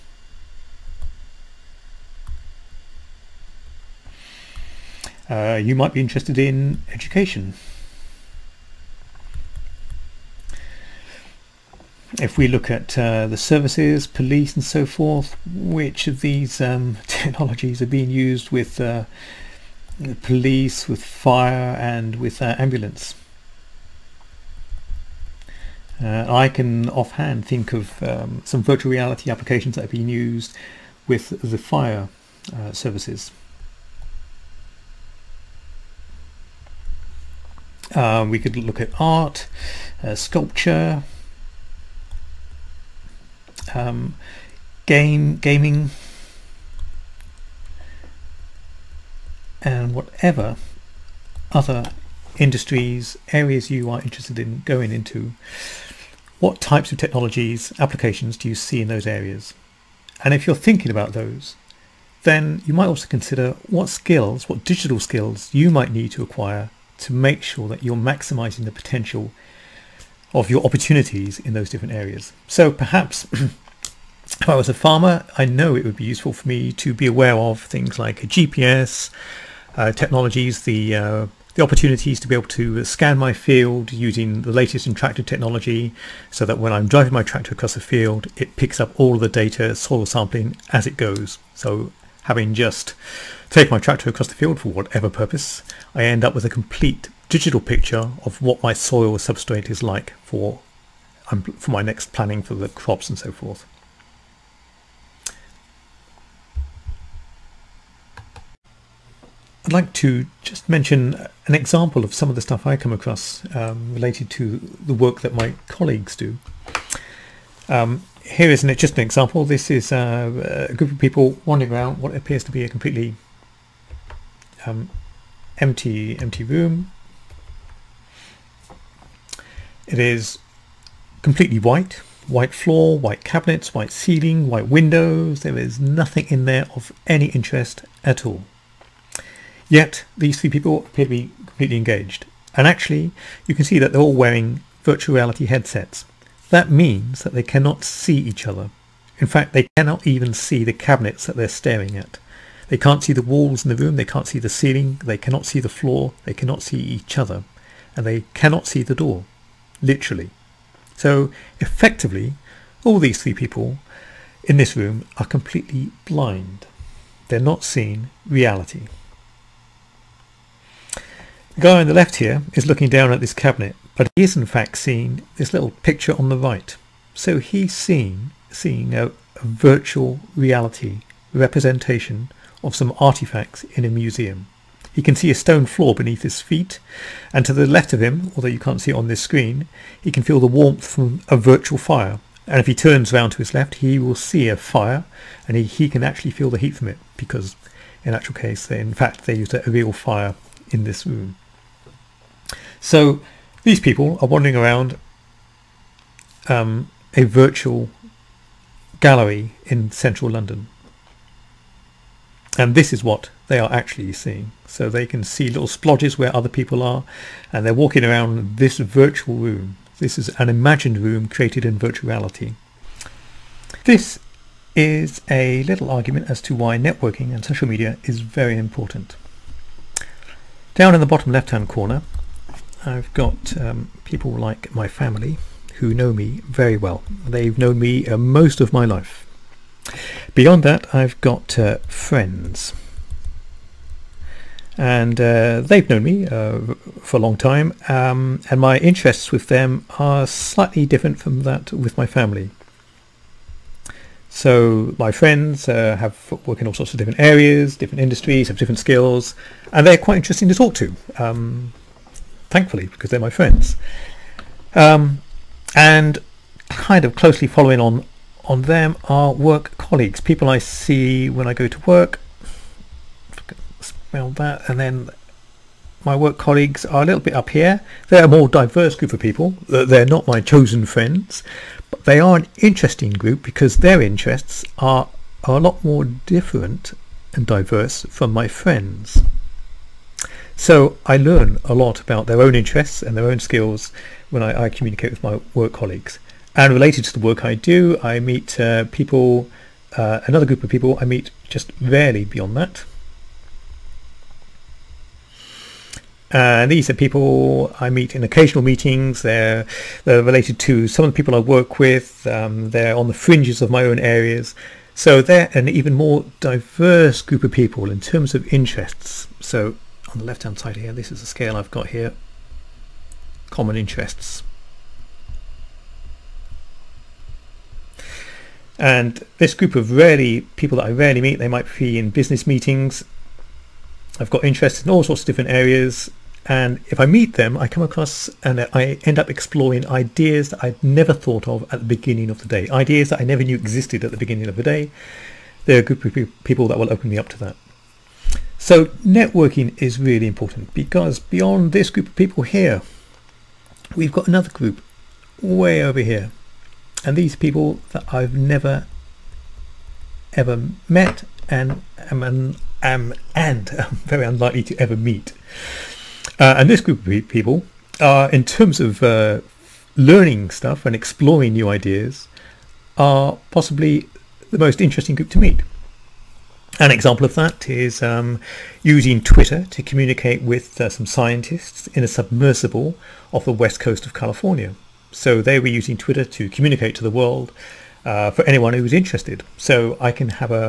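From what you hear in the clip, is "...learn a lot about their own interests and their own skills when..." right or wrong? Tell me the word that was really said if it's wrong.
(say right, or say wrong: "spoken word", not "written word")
right.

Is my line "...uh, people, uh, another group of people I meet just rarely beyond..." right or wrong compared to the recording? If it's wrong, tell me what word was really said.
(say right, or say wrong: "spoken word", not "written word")
right.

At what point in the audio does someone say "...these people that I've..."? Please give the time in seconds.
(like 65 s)
357 s.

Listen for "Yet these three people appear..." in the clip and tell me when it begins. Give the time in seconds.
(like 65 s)
139 s.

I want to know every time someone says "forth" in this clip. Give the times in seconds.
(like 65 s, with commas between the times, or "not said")
14 s, 103 s.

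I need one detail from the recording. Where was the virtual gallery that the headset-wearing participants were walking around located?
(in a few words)
central London.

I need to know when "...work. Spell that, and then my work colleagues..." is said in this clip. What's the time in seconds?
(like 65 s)
271 s.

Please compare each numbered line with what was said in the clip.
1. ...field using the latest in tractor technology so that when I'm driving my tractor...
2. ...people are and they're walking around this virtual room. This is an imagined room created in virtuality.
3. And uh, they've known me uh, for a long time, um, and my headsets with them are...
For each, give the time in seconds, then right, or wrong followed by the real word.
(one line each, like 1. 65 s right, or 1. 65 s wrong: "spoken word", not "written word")
1. 83 s right
2. 216 s right
3. 244 s wrong: "interests", not "headsets".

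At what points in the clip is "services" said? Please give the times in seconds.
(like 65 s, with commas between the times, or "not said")
13 s, 32 s.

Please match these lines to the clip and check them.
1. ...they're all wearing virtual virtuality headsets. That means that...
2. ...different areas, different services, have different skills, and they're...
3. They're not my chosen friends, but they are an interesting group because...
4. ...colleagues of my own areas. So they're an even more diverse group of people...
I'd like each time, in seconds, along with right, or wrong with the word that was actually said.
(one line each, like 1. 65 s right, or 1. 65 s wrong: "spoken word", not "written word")
1. 143 s wrong: "reality", not "virtuality"
2. 256 s wrong: "industries", not "services"
3. 279 s right
4. 313 s wrong: "fringes", not "colleagues".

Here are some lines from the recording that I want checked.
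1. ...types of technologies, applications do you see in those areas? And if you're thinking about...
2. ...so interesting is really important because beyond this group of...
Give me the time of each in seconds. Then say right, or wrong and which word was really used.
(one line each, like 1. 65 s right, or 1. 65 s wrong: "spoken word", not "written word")
1. 56 s right
2. 348 s wrong: "networking", not "interesting".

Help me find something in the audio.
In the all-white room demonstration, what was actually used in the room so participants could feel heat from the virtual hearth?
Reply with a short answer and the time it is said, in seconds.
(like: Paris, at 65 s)
a real fire, at 199 s.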